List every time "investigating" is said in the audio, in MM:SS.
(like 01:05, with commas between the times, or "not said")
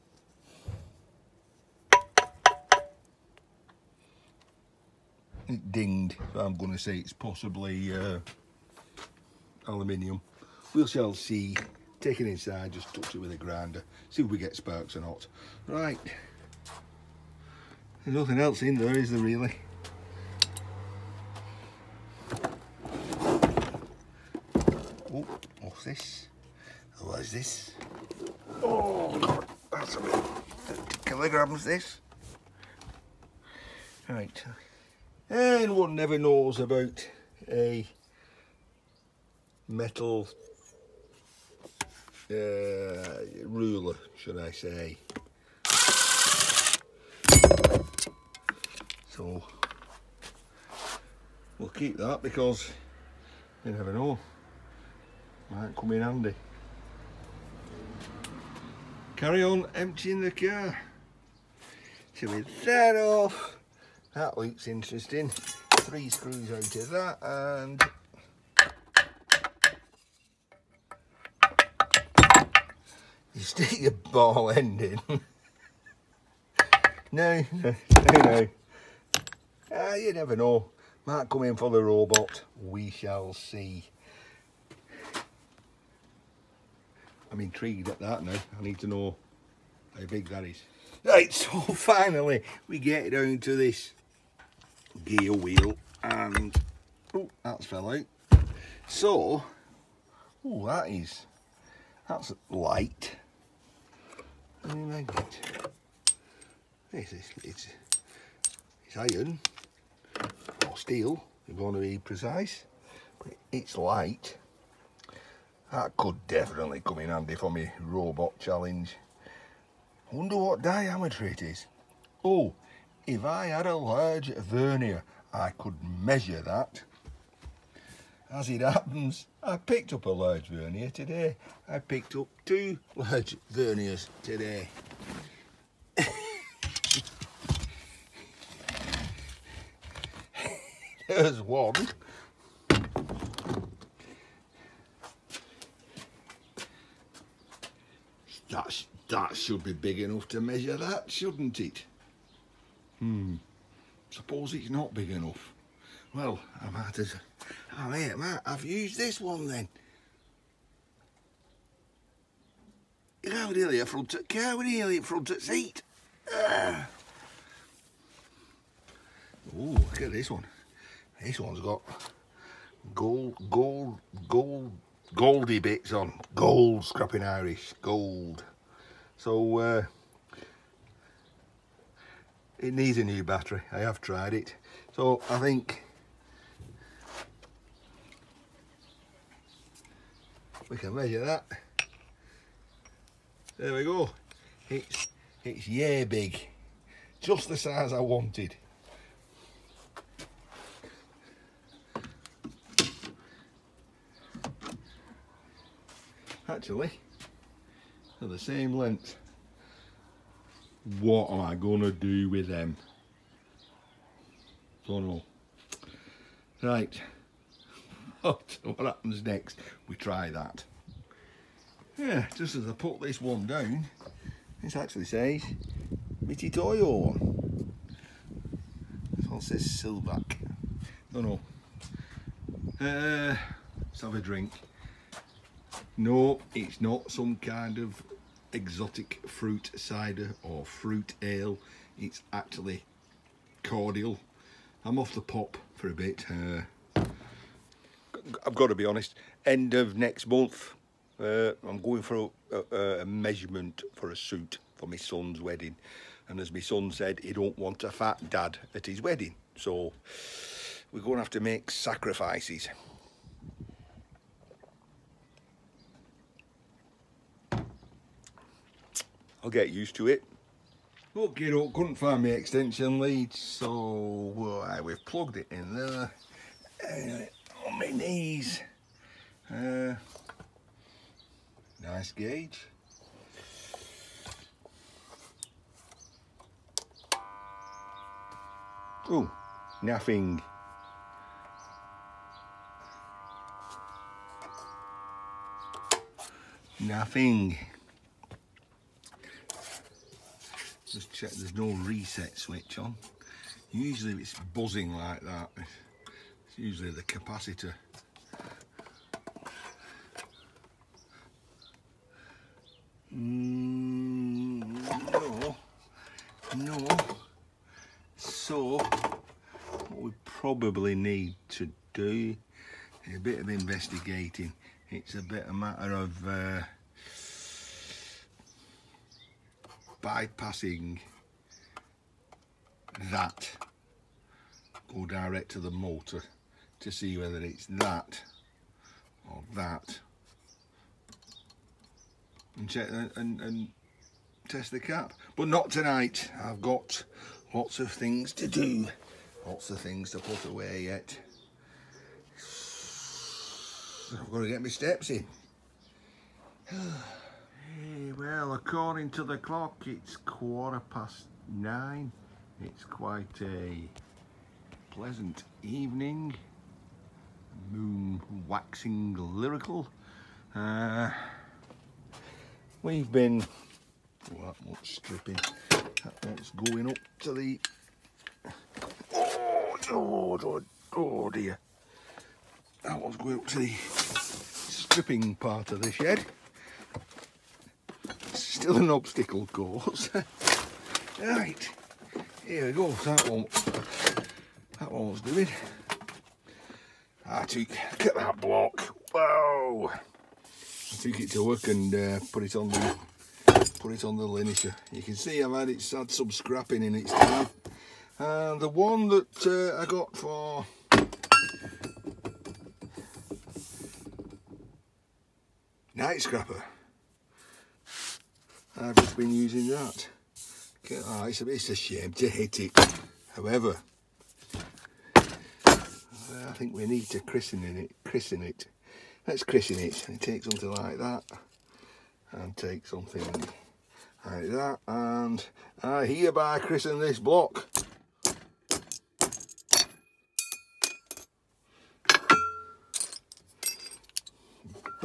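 05:23.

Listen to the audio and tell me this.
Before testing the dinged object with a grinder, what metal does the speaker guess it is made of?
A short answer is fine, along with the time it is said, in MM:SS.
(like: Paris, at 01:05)
aluminium, at 00:09.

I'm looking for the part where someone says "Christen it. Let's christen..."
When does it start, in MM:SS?
07:08.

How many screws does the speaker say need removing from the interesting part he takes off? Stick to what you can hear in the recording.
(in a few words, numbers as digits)
3.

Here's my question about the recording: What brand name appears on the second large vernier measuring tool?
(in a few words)
Sylvac.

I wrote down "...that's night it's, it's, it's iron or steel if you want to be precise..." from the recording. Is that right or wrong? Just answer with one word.
wrong.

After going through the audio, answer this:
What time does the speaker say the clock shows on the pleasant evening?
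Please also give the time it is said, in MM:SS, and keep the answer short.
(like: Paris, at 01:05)
quarter past nine, at 06:00.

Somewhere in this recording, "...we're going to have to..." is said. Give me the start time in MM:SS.
04:20.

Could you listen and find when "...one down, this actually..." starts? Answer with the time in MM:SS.
03:43.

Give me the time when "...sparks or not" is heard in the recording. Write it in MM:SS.
00:14.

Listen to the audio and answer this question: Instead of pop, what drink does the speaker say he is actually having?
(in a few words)
cordial.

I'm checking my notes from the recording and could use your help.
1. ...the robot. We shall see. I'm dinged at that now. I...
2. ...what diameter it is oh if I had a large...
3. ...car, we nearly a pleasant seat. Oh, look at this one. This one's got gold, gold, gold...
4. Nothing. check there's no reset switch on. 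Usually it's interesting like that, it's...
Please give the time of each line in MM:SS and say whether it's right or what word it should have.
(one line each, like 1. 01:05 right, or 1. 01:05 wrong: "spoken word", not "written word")
1. 01:21 wrong: "intrigued", not "dinged"
2. 02:00 right
3. 02:44 wrong: "front", not "pleasant"
4. 04:56 wrong: "buzzing", not "interesting".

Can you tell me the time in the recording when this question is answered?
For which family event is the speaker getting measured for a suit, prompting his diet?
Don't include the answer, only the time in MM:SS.
04:14.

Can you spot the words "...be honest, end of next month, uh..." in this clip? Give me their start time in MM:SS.
04:08.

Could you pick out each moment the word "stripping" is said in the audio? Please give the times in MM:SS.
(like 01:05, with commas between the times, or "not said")
06:14, 06:23.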